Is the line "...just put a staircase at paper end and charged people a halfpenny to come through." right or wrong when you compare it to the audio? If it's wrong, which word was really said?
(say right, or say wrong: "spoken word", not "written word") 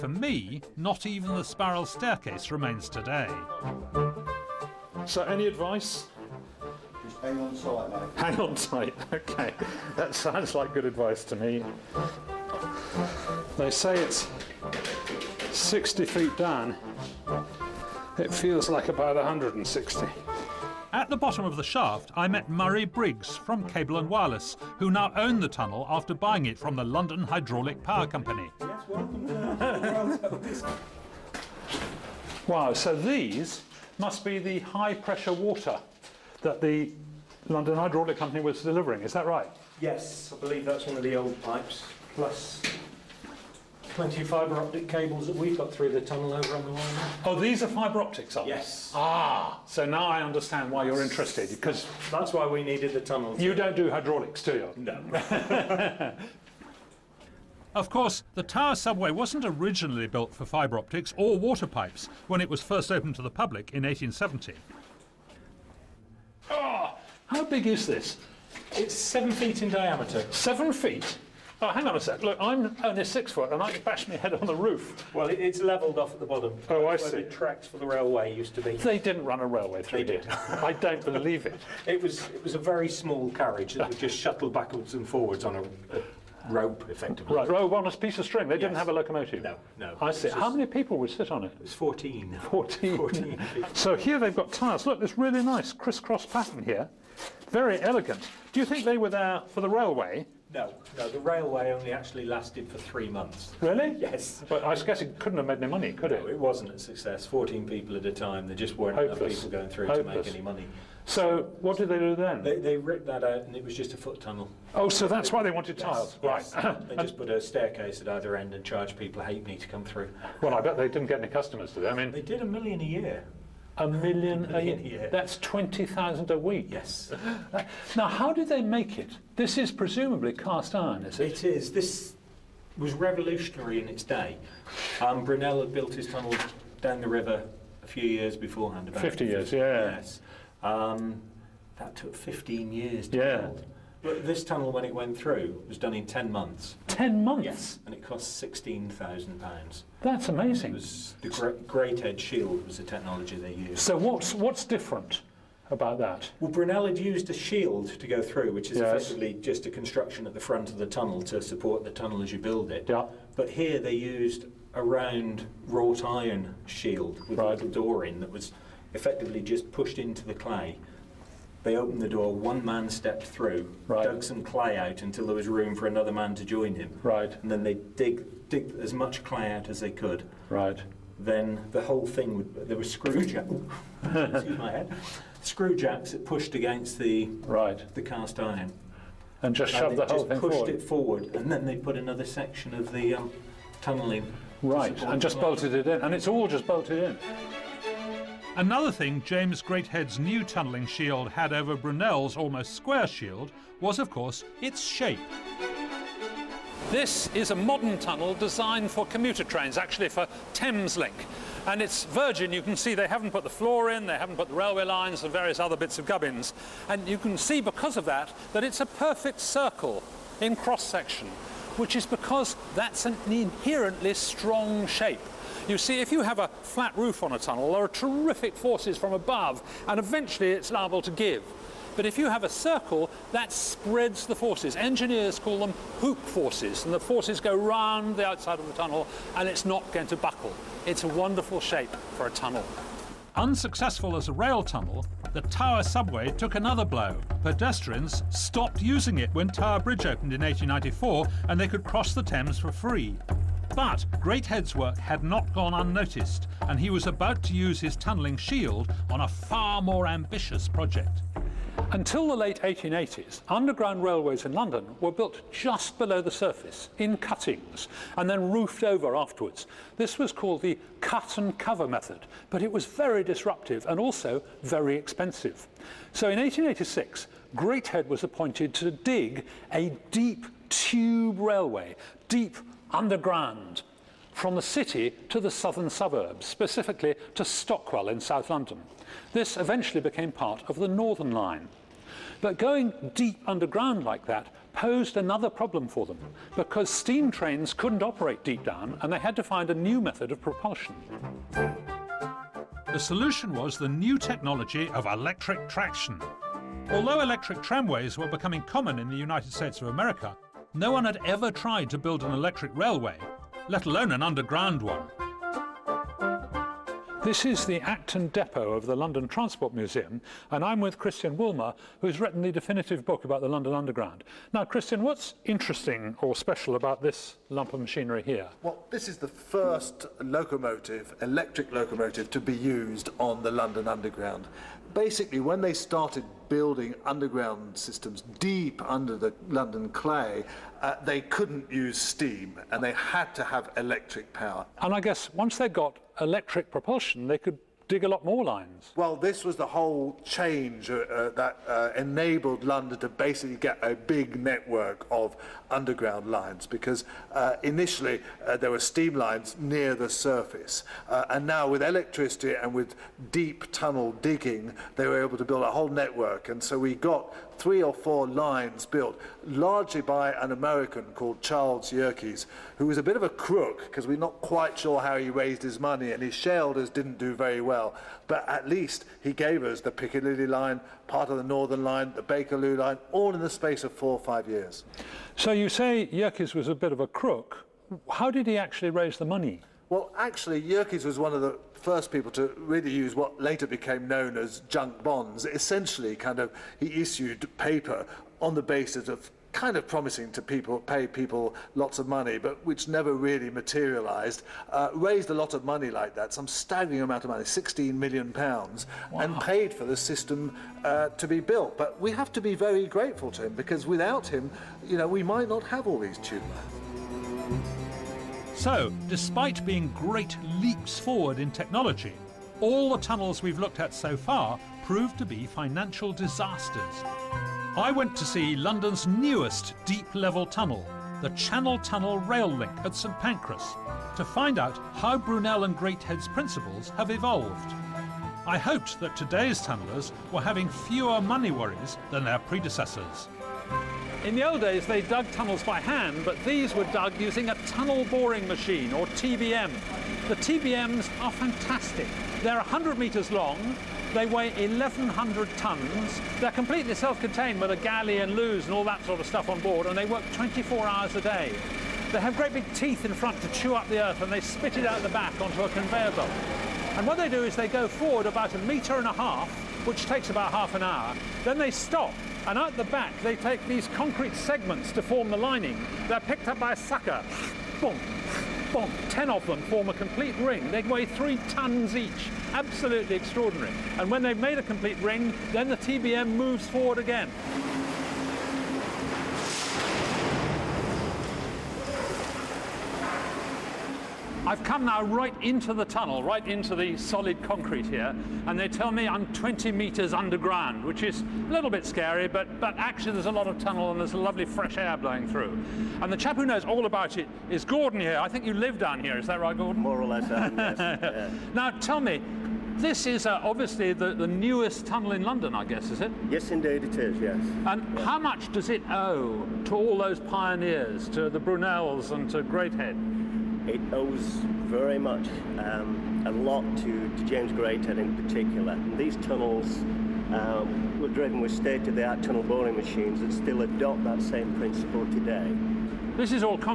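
wrong: "either", not "paper".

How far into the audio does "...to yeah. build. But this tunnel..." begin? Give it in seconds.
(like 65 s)
143 s.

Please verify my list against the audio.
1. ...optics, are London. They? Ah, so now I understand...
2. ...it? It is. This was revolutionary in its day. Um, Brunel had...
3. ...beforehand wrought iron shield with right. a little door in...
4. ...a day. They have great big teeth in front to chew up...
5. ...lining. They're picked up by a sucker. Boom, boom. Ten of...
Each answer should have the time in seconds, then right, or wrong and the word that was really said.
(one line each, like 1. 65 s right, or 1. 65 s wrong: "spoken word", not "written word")
1. 48 s wrong: "Yes", not "London"
2. 131 s right
3. 164 s wrong: "round", not "beforehand"
4. 461 s right
5. 475 s right.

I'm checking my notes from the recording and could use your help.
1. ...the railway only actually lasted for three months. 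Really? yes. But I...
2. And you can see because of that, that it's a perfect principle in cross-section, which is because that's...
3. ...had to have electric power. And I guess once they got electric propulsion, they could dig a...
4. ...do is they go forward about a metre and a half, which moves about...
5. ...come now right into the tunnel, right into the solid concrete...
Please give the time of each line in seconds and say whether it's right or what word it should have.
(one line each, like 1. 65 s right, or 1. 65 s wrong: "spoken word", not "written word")
1. 101 s right
2. 216 s wrong: "circle", not "principle"
3. 342 s right
4. 467 s wrong: "takes", not "moves"
5. 494 s right.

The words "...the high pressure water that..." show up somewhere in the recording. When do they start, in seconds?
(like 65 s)
34 s.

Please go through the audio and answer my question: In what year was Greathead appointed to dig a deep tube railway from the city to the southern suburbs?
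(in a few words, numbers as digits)
1886.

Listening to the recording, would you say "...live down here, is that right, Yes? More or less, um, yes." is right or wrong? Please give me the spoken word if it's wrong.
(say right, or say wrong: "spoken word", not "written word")
wrong: "Gordon", not "Yes".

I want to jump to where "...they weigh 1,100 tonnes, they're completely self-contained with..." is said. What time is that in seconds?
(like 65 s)
454 s.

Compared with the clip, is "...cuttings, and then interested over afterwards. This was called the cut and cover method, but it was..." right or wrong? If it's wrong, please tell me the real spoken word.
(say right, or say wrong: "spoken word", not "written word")
wrong: "roofed", not "interested".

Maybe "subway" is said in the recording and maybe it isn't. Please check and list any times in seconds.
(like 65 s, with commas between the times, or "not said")
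58 s, 245 s.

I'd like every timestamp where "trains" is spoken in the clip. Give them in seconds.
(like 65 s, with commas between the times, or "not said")
209 s, 297 s.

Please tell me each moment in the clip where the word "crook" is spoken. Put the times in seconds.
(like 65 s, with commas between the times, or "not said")
373 s, 387 s.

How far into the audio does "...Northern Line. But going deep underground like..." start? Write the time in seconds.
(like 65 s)
290 s.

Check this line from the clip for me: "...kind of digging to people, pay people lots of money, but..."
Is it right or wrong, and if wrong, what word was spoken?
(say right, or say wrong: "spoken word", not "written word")
wrong: "promising", not "digging".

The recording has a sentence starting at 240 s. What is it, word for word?
It's a wonderful shape for a tunnel.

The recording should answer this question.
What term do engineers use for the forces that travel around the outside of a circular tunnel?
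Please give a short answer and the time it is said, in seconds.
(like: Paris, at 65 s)
hoop forces, at 235 s.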